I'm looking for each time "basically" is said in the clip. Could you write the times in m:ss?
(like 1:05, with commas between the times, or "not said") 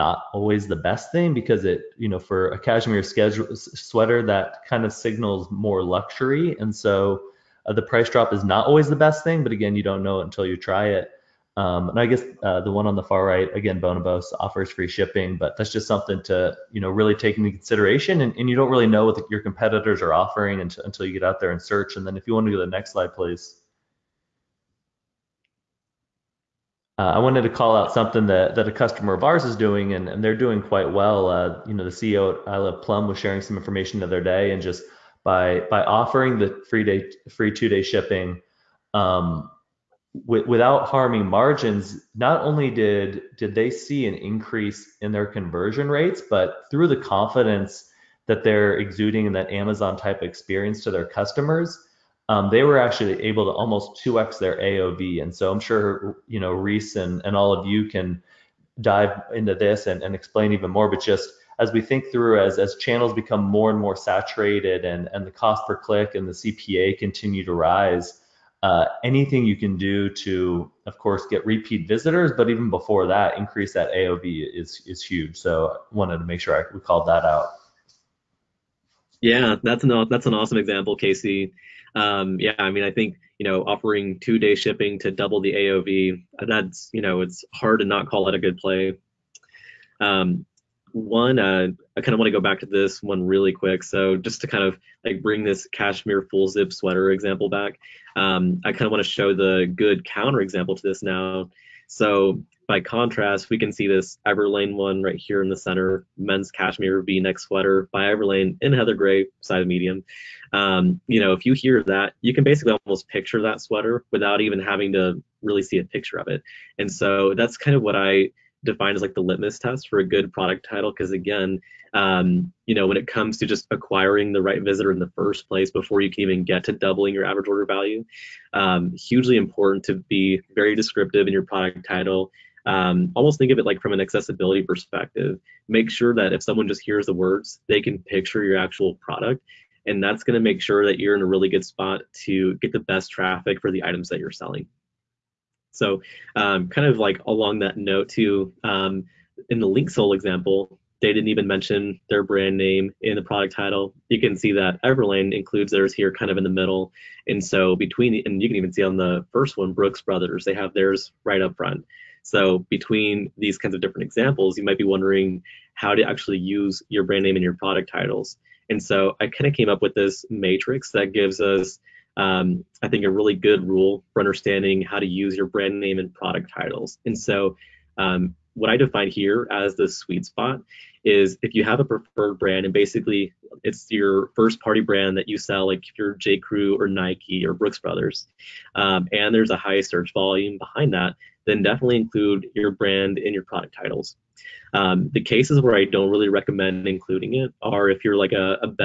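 1:52, 3:02.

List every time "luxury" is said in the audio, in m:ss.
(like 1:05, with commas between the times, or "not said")
0:05.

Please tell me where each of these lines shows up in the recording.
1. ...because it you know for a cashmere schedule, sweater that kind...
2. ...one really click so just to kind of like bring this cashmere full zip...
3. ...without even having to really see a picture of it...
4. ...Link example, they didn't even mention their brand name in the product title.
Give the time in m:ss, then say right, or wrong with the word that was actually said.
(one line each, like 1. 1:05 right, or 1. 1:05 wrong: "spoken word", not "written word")
1. 0:01 right
2. 1:33 wrong: "quick", not "click"
3. 1:54 right
4. 2:29 right.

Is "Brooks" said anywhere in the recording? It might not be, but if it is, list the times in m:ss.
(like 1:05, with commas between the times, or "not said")
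2:39, 3:07.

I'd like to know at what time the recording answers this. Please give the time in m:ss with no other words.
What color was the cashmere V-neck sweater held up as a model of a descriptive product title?
1:48.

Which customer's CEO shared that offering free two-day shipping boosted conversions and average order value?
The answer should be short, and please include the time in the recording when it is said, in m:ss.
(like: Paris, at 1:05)
I Love Plum, at 0:32.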